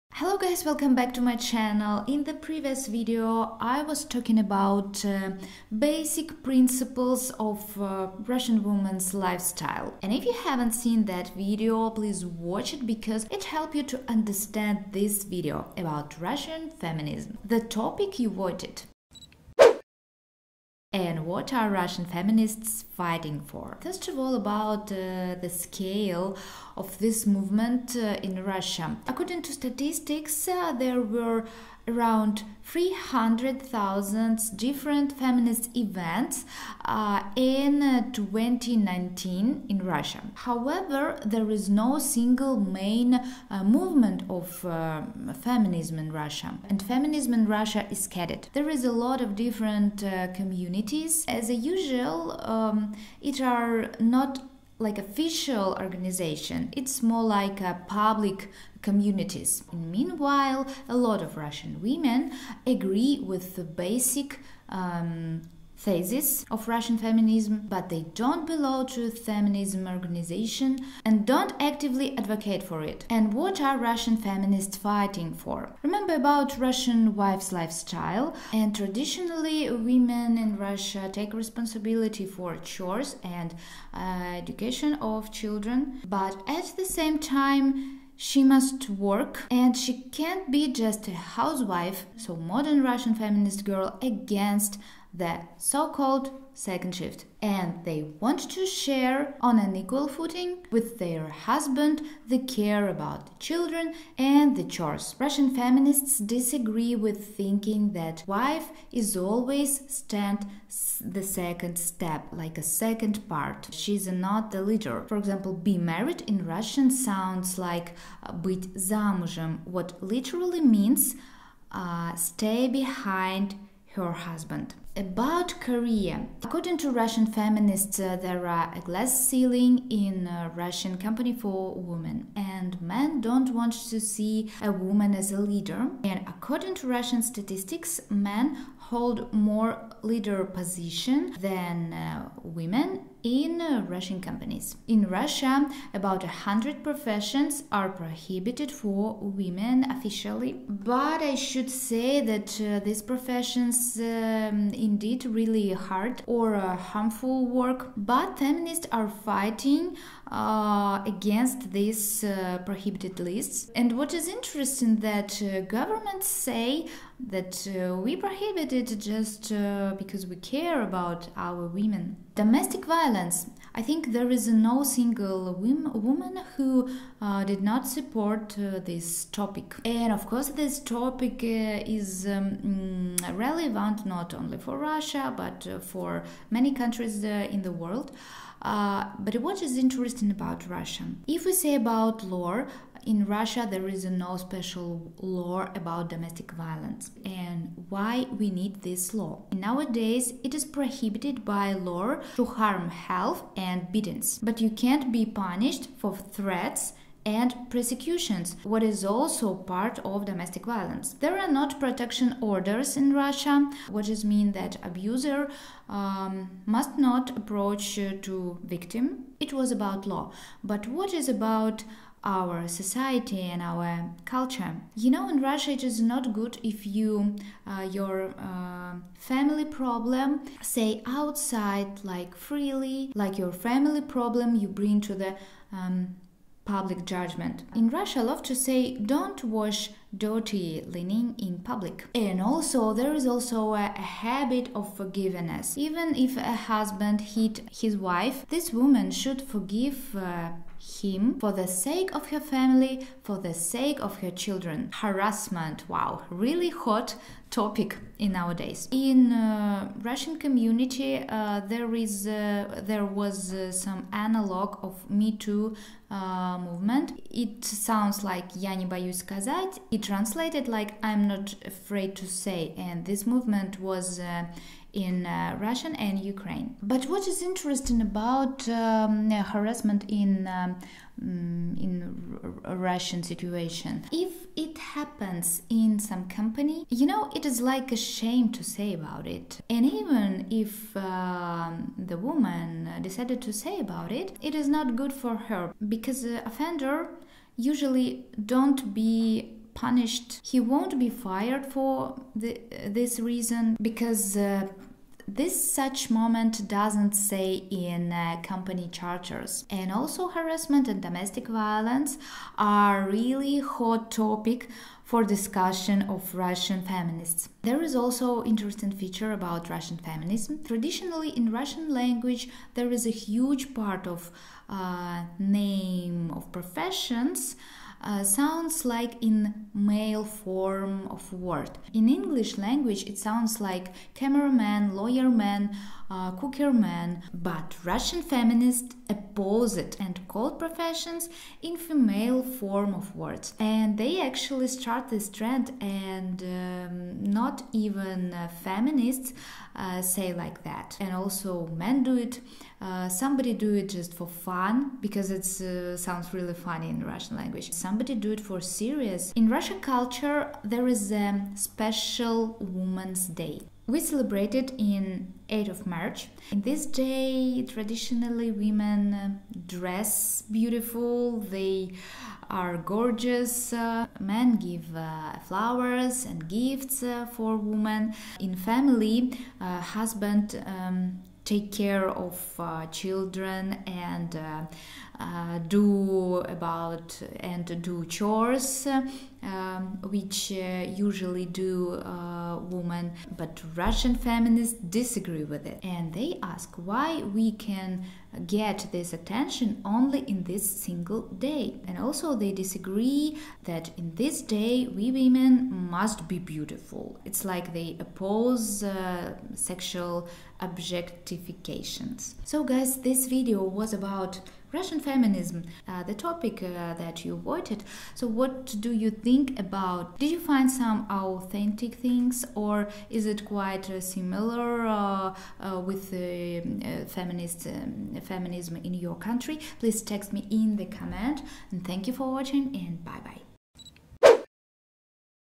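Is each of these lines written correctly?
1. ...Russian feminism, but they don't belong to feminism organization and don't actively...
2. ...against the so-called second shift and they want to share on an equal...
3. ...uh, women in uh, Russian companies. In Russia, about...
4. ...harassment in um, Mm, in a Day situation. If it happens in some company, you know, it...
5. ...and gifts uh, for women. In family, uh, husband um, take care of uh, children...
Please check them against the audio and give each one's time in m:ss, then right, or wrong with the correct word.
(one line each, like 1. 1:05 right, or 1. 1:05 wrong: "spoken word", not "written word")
1. 1:06 right
2. 1:33 right
3. 2:21 right
4. 4:39 wrong: "Russian", not "Day"
5. 6:16 right.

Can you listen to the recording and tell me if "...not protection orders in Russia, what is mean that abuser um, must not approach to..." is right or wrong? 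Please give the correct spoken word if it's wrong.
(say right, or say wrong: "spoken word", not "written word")
right.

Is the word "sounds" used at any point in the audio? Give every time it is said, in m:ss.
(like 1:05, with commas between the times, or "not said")
1:56, 4:27, 5:28, 5:33, 5:55.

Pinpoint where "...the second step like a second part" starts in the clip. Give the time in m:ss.
1:51.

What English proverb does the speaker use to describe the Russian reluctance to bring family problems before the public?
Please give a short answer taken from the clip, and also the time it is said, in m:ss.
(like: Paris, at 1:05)
don't wash dirty linen in public, at 3:58.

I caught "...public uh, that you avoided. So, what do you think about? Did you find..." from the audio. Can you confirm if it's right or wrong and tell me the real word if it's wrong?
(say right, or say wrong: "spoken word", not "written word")
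wrong: "topic", not "public".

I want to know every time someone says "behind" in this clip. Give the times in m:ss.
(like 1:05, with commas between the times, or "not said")
2:02.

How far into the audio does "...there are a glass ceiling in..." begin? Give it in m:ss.
2:08.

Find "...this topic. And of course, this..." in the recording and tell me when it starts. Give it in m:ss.
2:58.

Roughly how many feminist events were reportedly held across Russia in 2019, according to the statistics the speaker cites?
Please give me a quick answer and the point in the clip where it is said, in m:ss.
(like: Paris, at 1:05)
300,000, at 0:32.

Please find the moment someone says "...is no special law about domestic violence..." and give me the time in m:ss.
3:13.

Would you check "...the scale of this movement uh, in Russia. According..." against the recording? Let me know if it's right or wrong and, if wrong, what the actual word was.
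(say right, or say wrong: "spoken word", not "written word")
right.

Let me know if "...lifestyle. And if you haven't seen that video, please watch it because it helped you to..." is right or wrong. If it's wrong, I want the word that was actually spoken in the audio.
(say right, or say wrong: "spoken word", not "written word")
right.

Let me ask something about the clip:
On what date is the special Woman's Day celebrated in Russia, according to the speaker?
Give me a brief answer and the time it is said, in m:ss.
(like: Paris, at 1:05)
8th of March, at 6:05.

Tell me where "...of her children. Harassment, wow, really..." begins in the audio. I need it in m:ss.
4:14.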